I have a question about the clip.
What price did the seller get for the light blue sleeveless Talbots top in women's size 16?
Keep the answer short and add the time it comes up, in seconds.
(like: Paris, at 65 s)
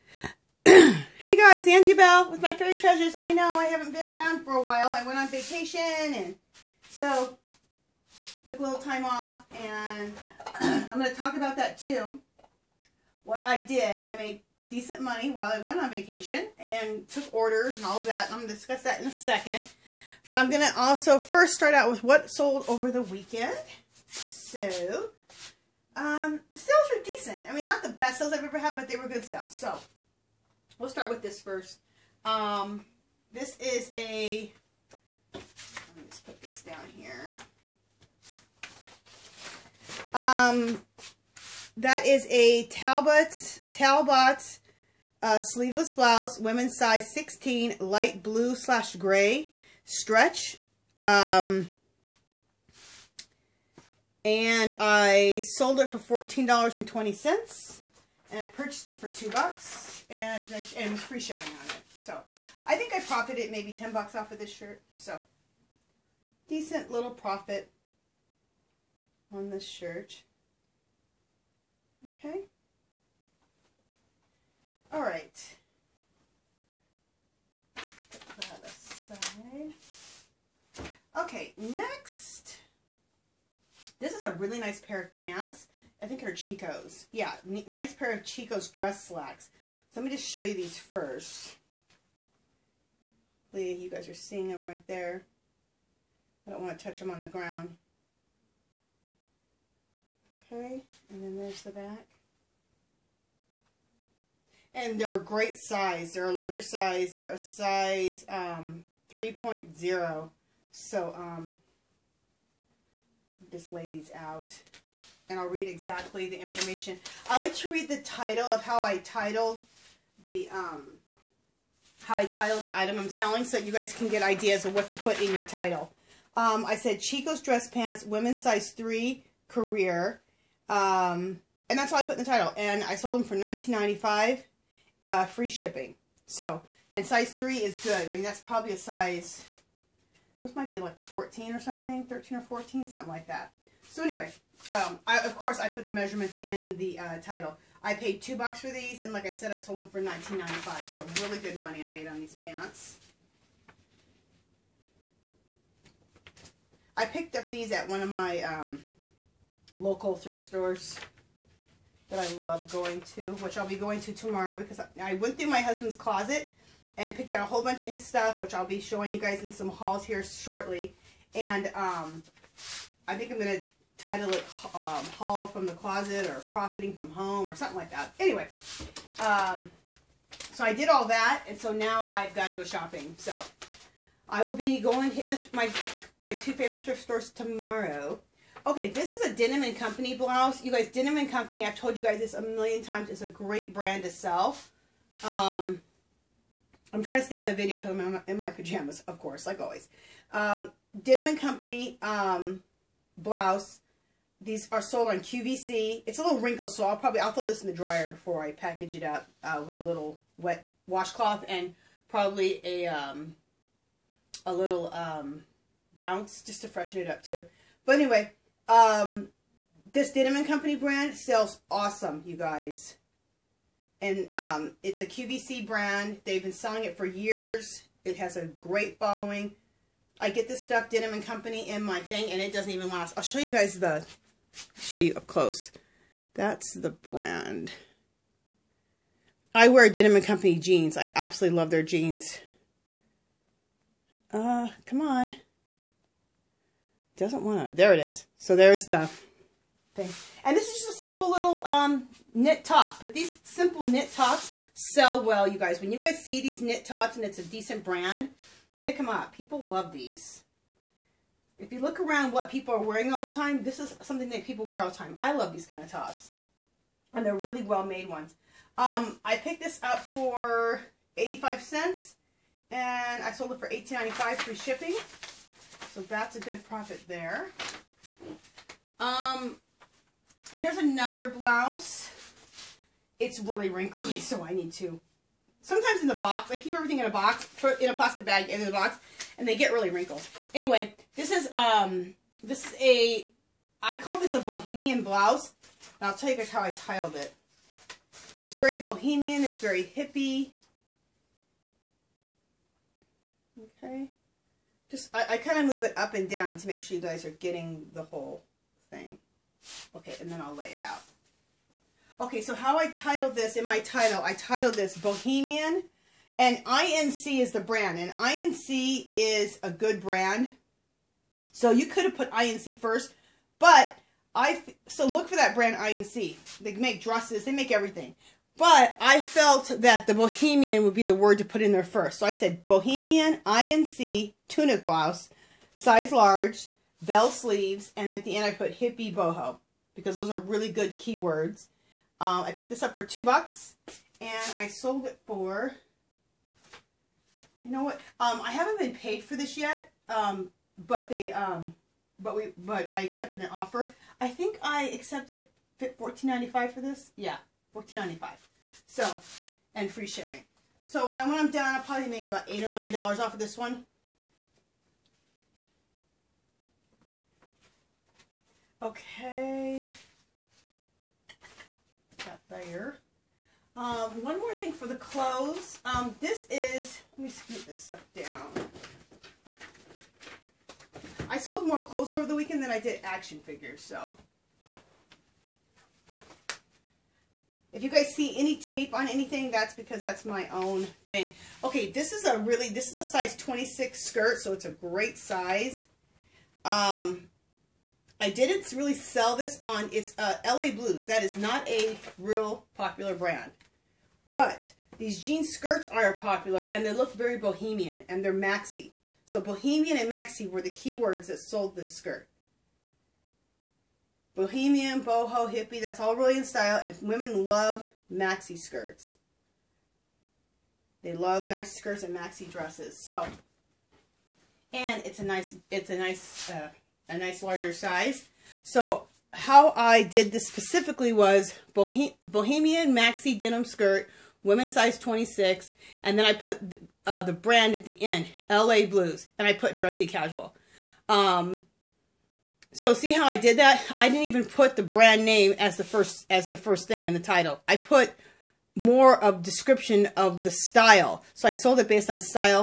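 $14.20, at 55 s.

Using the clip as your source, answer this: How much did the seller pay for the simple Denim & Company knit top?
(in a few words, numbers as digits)
85 cents.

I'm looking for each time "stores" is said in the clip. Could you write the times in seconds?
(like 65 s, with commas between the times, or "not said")
160 s, 187 s.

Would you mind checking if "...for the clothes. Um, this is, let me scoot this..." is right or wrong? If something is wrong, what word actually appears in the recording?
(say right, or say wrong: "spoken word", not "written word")
right.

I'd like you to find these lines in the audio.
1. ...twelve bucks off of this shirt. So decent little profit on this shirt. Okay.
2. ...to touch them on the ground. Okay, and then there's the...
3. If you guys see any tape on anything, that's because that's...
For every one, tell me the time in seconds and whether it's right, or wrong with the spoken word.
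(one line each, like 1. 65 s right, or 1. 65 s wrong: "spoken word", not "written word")
1. 63 s wrong: "ten", not "twelve"
2. 96 s right
3. 387 s right.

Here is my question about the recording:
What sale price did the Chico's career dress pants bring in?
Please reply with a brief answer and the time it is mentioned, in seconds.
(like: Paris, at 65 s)
$19.95, at 133 s.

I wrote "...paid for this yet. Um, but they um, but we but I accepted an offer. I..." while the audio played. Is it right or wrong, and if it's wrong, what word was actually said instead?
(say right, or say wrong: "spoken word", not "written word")
right.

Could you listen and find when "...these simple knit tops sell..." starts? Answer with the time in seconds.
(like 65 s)
253 s.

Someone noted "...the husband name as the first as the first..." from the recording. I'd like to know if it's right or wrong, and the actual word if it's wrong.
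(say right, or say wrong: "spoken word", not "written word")
wrong: "brand", not "husband".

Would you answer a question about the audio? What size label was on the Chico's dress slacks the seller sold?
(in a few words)
3.0.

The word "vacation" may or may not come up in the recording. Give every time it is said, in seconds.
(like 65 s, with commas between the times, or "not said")
5 s, 15 s.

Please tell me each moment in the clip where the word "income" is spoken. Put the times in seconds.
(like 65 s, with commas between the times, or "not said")
not said.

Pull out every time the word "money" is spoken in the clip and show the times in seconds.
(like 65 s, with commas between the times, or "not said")
15 s, 151 s.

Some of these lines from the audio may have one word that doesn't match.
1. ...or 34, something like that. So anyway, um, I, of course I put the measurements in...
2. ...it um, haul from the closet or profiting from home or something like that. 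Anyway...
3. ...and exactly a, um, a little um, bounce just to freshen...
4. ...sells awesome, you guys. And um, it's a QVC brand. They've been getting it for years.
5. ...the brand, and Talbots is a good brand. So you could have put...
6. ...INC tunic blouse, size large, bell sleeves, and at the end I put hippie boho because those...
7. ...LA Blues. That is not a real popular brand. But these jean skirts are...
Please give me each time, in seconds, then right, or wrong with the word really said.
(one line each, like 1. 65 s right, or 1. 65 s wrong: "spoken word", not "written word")
1. 142 s wrong: "14", not "34"
2. 174 s right
3. 211 s wrong: "probably", not "exactly"
4. 221 s wrong: "selling", not "getting"
5. 317 s wrong: "INC", not "Talbots"
6. 333 s right
7. 400 s right.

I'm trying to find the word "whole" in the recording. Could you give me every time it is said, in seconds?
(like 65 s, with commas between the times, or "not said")
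167 s, 308 s.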